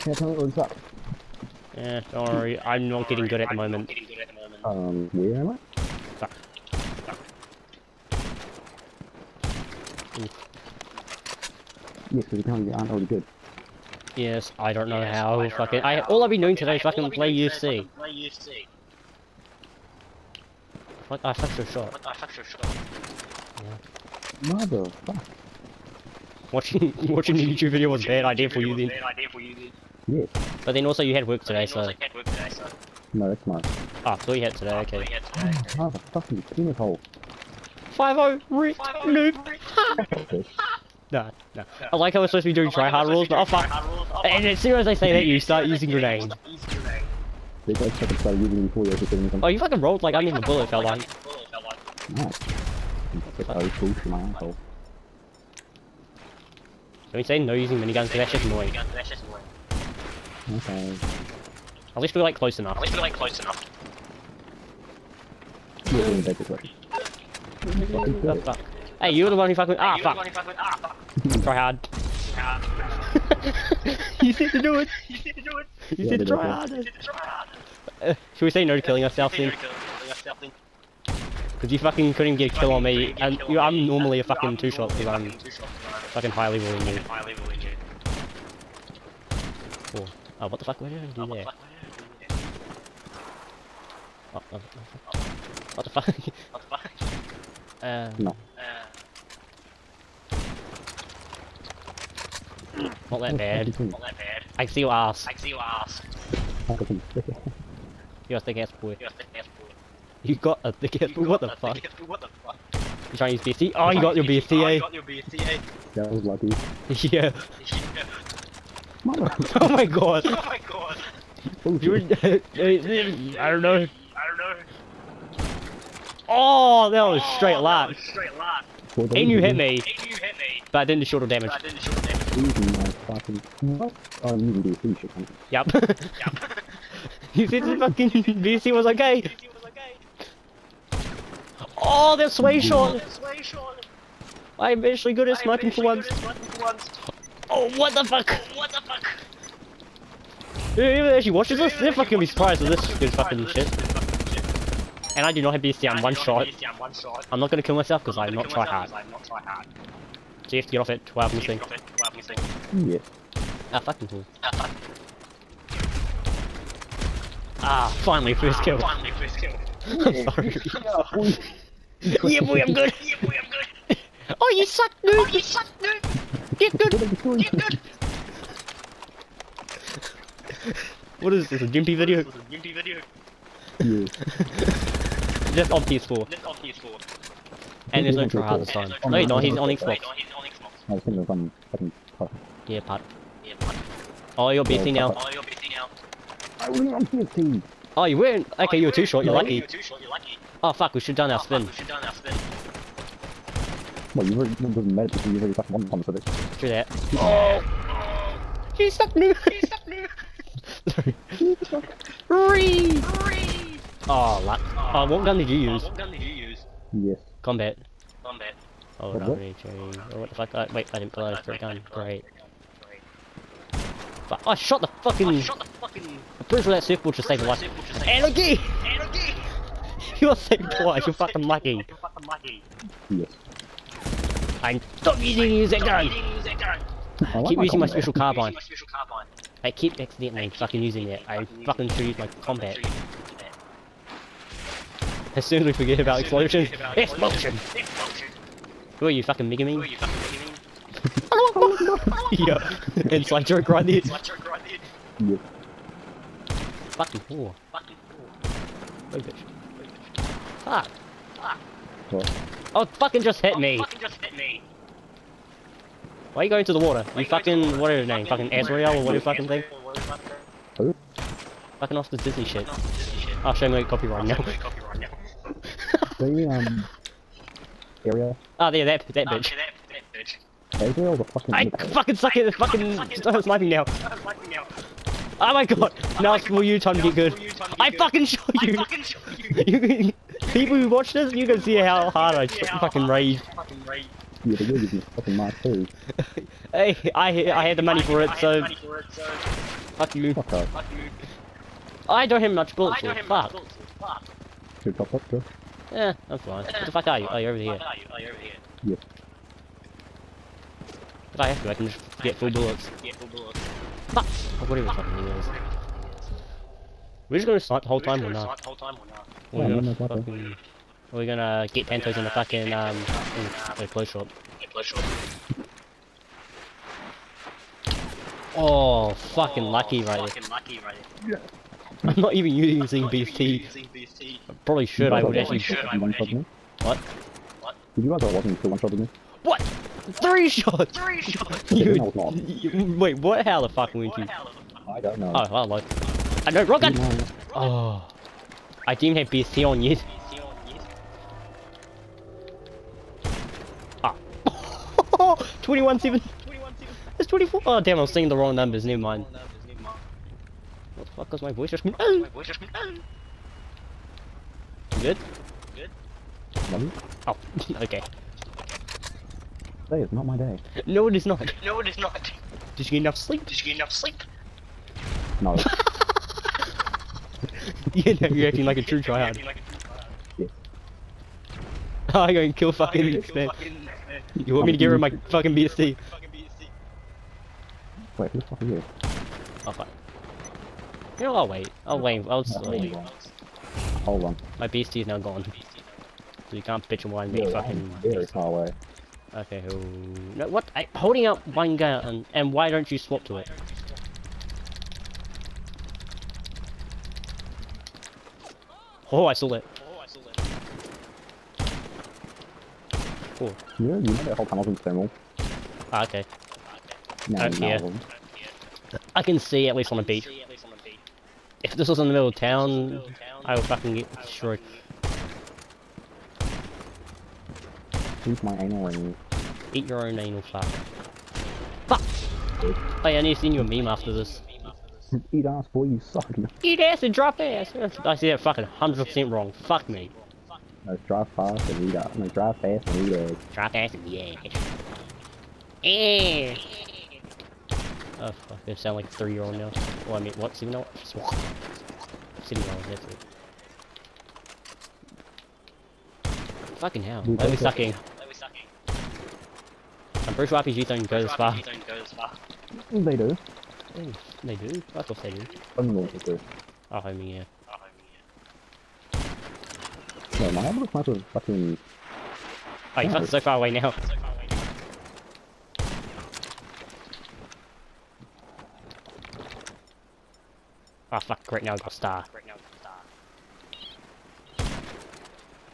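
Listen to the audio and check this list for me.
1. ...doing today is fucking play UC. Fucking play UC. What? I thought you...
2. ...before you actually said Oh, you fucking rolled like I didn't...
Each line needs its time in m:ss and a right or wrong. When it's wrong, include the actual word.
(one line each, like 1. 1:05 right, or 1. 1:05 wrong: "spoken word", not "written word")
1. 0:16 right
2. 0:48 right.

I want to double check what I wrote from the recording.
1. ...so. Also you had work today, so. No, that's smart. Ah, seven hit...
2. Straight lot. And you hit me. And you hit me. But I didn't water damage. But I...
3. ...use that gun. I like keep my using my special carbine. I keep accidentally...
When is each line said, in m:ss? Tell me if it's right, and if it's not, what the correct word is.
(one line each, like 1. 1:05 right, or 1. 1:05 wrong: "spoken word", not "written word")
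1. 0:31 wrong: "three", not "seven"
2. 2:08 wrong: "shoulder", not "water"
3. 3:55 right.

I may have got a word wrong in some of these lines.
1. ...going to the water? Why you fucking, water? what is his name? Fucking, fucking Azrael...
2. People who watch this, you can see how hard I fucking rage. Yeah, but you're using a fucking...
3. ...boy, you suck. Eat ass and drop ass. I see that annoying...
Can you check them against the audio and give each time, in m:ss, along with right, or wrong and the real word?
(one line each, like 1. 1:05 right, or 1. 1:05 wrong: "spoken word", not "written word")
1. 4:26 right
2. 4:50 right
3. 7:15 wrong: "fucking", not "annoying".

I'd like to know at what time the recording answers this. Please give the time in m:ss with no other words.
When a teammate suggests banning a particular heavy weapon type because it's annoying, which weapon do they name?
0:57.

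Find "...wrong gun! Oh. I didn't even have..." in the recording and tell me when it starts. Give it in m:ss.
5:46.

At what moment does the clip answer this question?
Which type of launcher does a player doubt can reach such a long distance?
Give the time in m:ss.
7:40.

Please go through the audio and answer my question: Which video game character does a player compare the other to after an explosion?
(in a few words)
Mega Man.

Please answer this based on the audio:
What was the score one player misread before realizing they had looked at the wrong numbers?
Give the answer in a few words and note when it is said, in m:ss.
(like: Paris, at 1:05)
21-7, at 5:55.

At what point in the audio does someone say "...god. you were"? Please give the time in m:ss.
2:01.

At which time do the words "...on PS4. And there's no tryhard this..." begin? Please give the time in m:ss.
3:06.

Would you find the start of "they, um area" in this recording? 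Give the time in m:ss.
4:36.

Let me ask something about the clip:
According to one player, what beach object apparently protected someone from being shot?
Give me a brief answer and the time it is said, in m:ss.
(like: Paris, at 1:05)
Surfboard, at 3:46.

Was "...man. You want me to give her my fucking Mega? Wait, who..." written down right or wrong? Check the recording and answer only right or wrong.
wrong.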